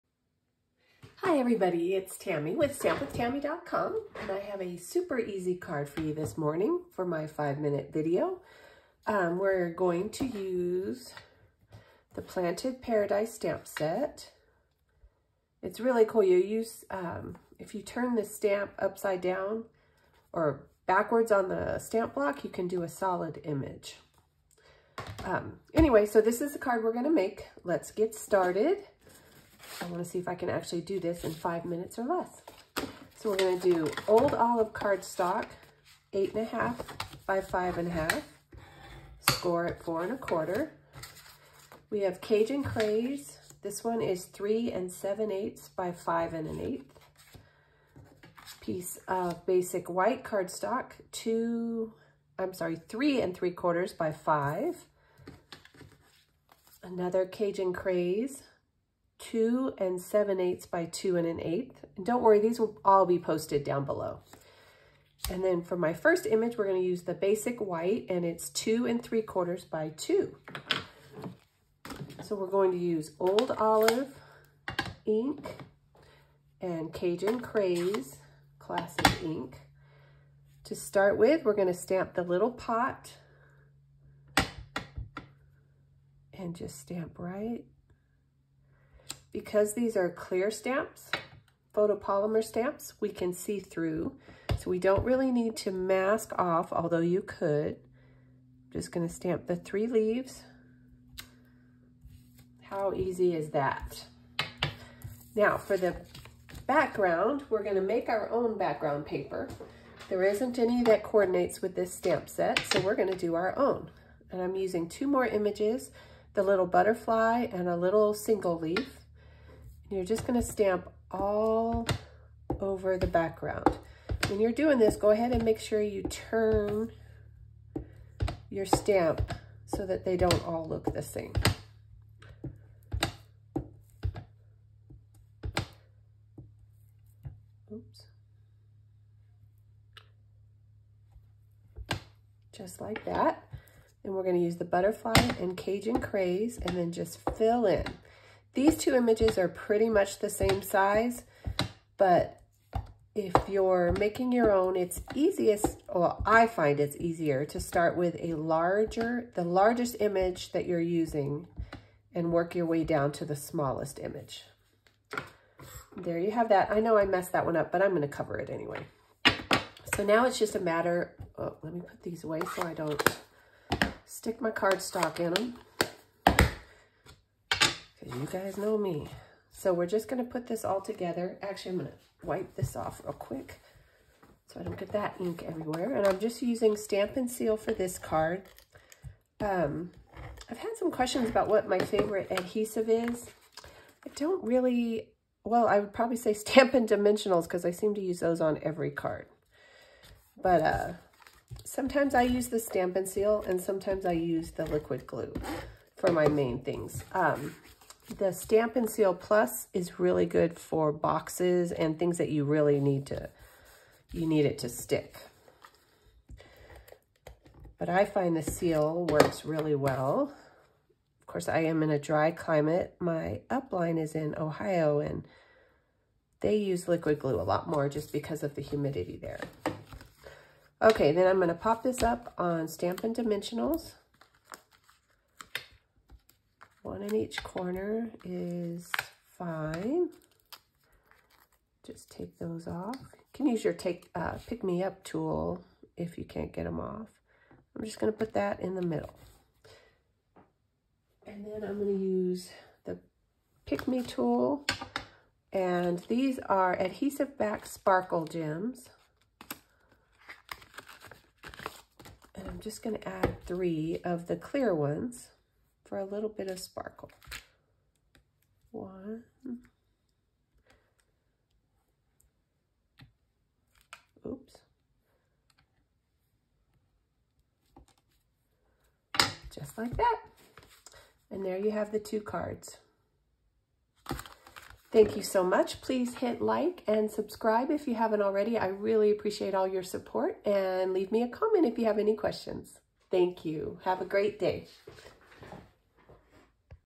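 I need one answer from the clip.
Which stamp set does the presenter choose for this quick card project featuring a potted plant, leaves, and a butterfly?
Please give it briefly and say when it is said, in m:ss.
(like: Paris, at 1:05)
Planted Paradise, at 0:12.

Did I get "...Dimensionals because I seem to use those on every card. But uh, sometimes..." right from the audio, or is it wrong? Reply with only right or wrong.
right.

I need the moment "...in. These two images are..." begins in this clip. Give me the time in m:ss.
2:27.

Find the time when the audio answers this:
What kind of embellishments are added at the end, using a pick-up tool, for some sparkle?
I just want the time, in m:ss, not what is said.
4:16.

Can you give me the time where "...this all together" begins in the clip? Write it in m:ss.
3:00.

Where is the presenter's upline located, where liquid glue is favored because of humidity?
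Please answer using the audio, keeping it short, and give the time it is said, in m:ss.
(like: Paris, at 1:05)
Ohio, at 3:44.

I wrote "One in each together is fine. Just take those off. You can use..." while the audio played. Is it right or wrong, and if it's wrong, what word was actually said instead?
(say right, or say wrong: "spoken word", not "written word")
wrong: "corner", not "together".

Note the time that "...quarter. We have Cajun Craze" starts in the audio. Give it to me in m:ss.
0:40.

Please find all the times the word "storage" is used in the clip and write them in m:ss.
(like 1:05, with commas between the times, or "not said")
not said.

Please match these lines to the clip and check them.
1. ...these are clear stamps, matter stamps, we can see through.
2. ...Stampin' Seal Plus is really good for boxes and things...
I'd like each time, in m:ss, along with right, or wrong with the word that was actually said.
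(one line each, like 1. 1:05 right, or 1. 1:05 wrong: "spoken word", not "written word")
1. 1:29 wrong: "photopolymer", not "matter"
2. 3:28 right.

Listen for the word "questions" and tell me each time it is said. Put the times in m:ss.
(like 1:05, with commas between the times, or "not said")
3:10, 4:52.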